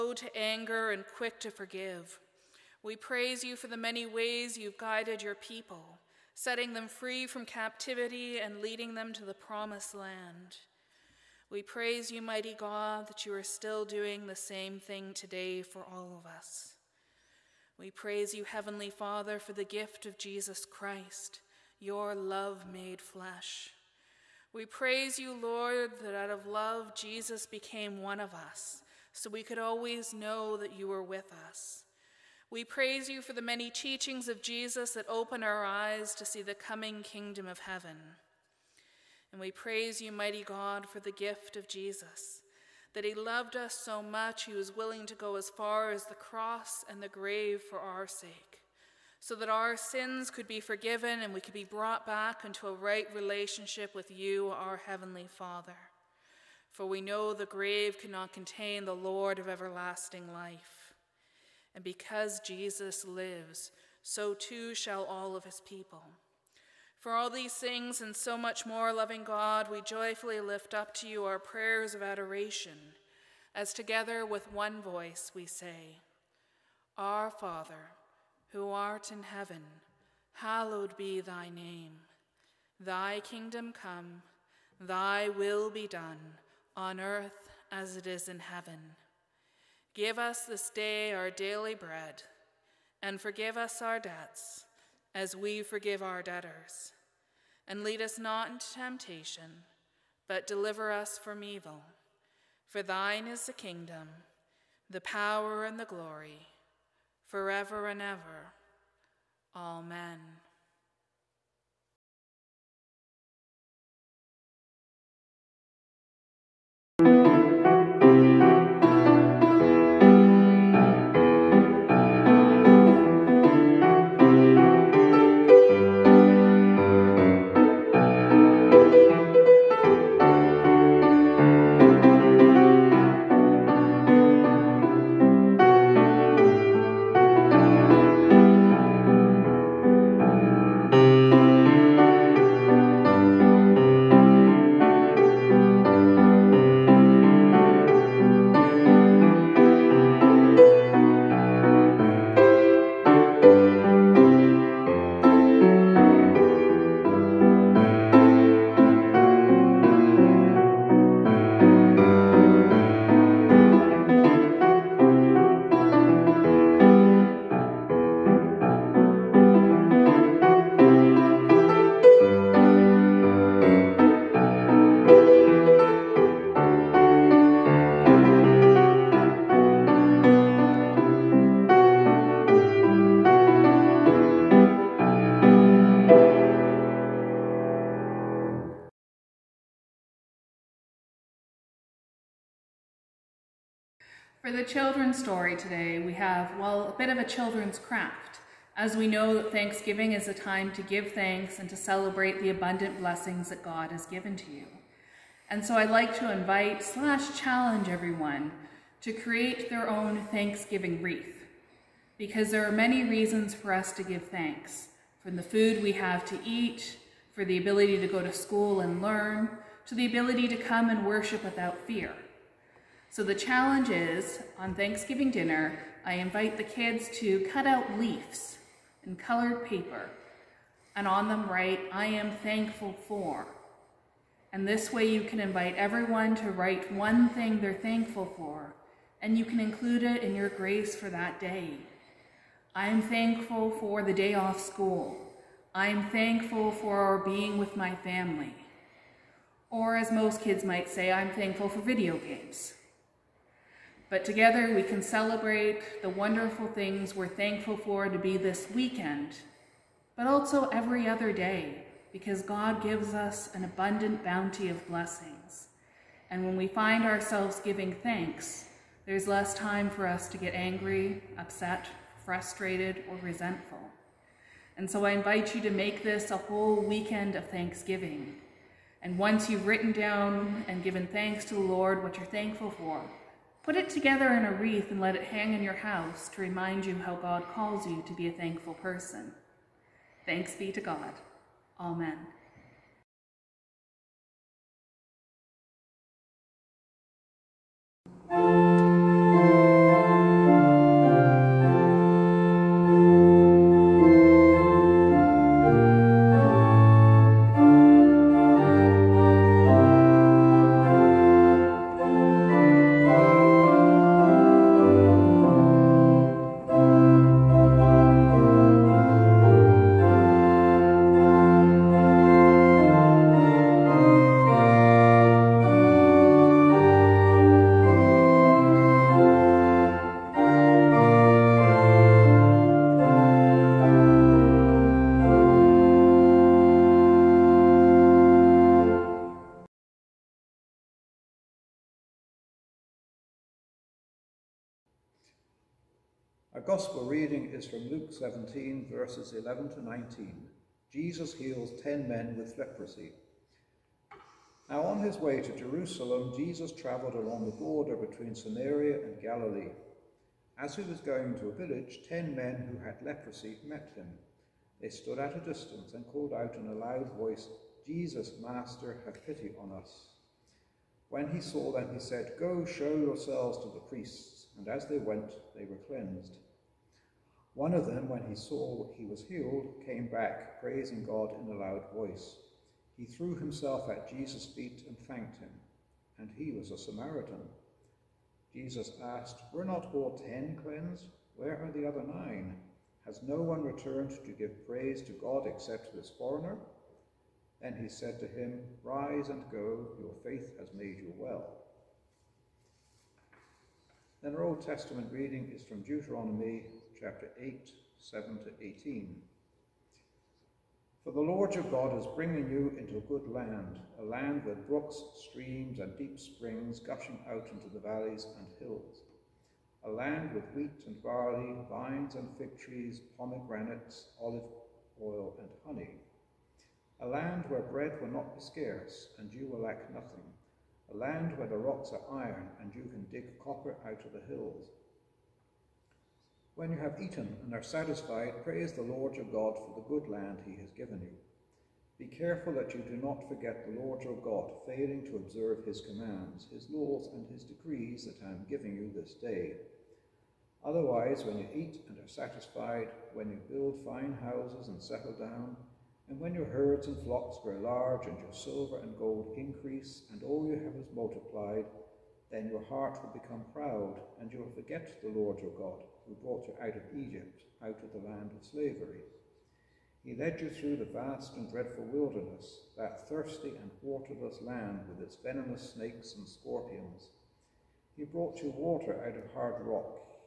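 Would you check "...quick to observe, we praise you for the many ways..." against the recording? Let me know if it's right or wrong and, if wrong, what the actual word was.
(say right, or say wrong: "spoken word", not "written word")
wrong: "forgive", not "observe".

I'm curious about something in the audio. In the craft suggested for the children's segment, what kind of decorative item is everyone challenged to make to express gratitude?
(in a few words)
Thanksgiving wreath.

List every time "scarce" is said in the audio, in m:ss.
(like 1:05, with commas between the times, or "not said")
7:08.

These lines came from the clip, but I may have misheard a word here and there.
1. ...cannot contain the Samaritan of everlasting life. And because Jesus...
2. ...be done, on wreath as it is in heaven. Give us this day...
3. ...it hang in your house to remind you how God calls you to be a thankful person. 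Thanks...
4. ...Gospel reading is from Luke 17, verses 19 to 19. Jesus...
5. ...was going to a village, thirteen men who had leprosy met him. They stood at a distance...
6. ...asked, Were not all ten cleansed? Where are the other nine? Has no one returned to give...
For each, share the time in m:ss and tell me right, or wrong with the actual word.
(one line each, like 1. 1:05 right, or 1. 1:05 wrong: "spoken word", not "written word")
1. 0:57 wrong: "Lord", not "Samaritan"
2. 1:25 wrong: "earth", not "wreath"
3. 4:45 right
4. 5:46 wrong: "11", not "19"
5. 6:00 wrong: "ten", not "thirteen"
6. 6:29 right.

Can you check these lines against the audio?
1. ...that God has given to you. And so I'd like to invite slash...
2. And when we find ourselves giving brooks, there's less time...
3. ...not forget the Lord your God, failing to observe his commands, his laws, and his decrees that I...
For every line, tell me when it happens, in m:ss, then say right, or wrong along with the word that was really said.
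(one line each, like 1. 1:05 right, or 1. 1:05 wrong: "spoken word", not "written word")
1. 3:23 right
2. 4:26 wrong: "thanks", not "brooks"
3. 7:22 right.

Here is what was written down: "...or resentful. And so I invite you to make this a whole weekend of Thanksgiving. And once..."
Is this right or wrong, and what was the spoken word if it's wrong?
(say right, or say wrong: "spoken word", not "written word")
right.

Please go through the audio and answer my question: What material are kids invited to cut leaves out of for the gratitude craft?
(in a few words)
colored paper.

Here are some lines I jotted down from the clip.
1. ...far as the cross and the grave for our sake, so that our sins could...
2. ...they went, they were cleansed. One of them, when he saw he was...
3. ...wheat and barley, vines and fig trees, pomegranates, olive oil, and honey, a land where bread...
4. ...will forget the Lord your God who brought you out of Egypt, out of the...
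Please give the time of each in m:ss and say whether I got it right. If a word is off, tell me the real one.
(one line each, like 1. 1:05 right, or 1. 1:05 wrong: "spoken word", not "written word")
1. 0:45 right
2. 6:14 right
3. 7:00 right
4. 7:44 right.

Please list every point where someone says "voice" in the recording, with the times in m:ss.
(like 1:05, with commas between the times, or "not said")
1:14, 6:07, 6:21.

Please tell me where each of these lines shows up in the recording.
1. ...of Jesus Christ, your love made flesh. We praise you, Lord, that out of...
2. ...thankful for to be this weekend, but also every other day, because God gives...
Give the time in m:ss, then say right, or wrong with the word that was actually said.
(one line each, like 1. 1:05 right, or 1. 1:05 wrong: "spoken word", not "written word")
1. 0:20 right
2. 4:17 right.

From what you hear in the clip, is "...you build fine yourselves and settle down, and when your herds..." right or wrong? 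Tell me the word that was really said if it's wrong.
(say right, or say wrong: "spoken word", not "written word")
wrong: "houses", not "yourselves".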